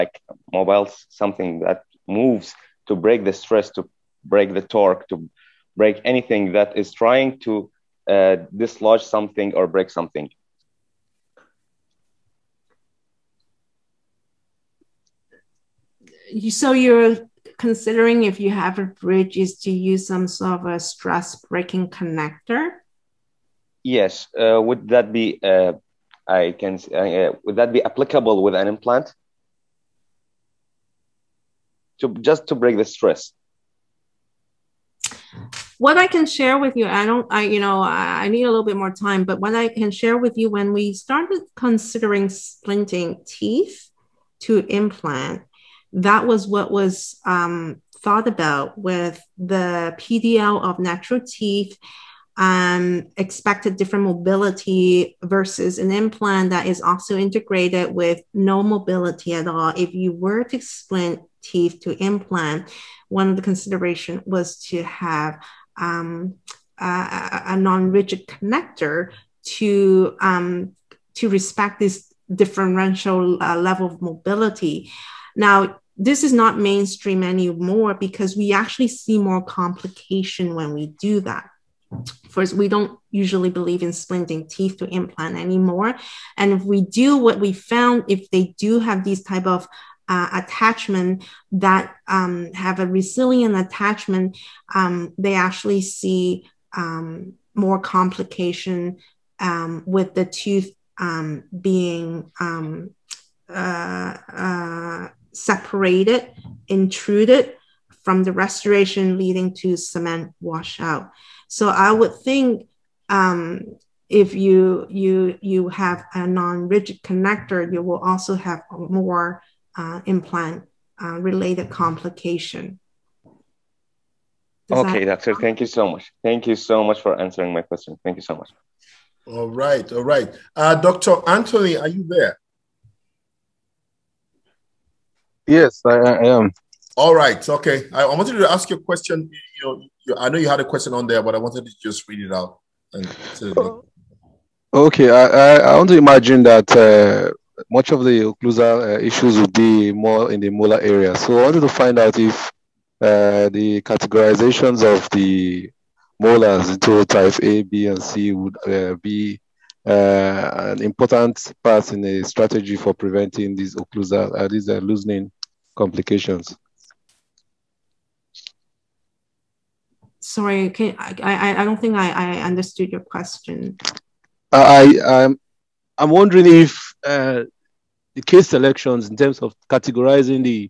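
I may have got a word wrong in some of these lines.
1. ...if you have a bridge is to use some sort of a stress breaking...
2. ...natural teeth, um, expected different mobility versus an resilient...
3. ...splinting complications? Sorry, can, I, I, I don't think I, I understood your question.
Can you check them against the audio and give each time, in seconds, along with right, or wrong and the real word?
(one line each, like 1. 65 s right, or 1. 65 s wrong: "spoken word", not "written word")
1. 18 s right
2. 50 s wrong: "implant", not "resilient"
3. 164 s wrong: "loosening", not "splinting".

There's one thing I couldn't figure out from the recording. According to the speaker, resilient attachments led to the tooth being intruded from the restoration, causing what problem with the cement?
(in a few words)
cement washout.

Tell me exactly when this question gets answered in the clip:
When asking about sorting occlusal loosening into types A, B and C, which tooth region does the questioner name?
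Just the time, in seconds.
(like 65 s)
150 s.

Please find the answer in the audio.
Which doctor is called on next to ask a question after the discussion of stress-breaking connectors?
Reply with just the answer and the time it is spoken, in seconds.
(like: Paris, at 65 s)
Dr. Anthony, at 130 s.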